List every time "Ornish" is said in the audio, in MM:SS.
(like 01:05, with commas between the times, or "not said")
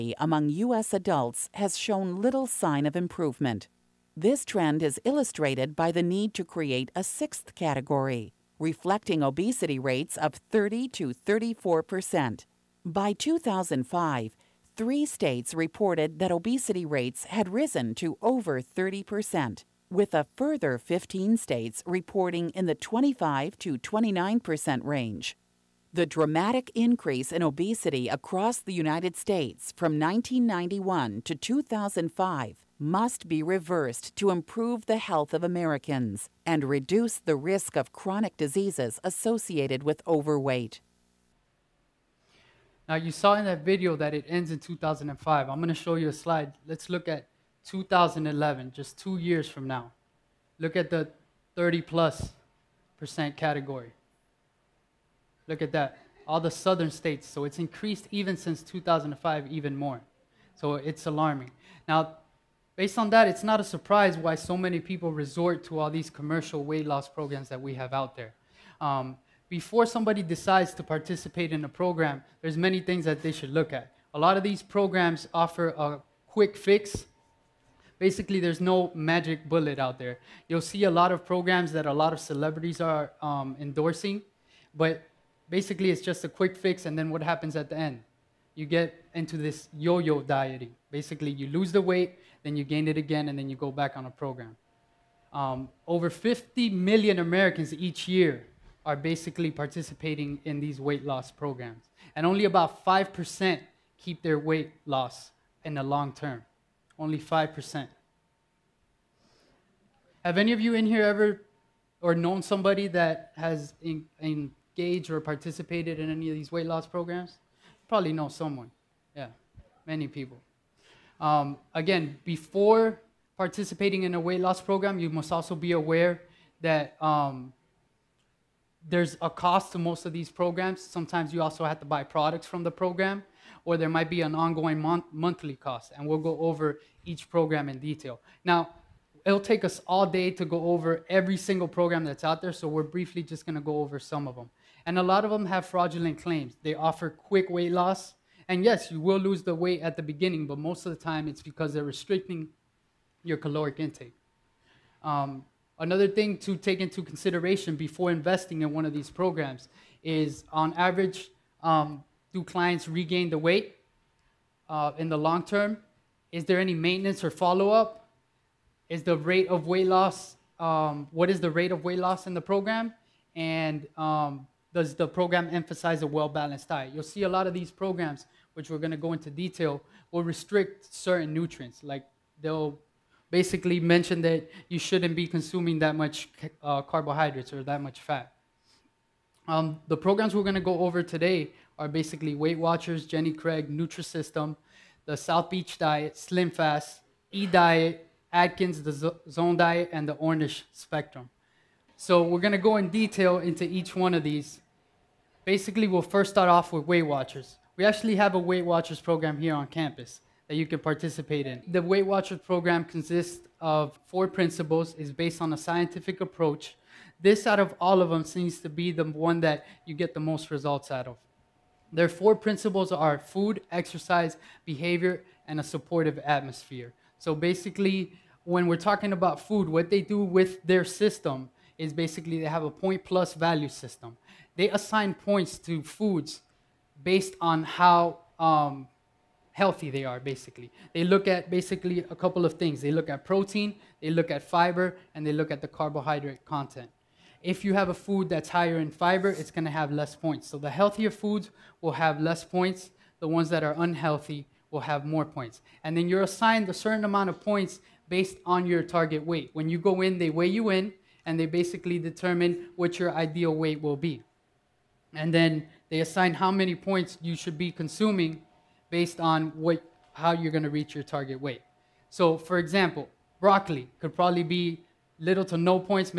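03:20.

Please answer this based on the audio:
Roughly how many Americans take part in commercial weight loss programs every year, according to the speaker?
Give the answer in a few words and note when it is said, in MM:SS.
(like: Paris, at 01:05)
50 million, at 01:35.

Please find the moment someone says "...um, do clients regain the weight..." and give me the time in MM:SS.
02:41.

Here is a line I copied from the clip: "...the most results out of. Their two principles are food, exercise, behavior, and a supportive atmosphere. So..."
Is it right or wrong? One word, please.
wrong.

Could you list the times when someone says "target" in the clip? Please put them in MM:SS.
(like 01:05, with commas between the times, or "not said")
04:18, 04:31.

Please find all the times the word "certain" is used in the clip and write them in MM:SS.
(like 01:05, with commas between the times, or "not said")
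03:00, 04:16.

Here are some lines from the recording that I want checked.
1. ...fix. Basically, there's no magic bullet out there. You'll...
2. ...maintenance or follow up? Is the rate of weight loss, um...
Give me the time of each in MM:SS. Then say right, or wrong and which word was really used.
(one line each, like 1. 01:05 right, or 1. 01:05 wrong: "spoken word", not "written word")
1. 01:16 right
2. 02:46 right.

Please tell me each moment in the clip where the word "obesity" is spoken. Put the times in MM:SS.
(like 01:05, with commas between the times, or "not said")
00:09, 00:16, 00:27.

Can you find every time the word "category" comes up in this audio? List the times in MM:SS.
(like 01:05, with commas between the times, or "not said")
00:07, 00:53.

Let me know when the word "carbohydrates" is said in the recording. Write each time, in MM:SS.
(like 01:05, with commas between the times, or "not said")
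03:06, 04:05.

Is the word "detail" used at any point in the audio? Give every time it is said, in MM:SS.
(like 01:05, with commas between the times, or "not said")
02:17, 02:59, 03:22.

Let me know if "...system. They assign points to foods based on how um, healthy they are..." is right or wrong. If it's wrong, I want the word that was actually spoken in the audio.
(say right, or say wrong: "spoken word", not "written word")
right.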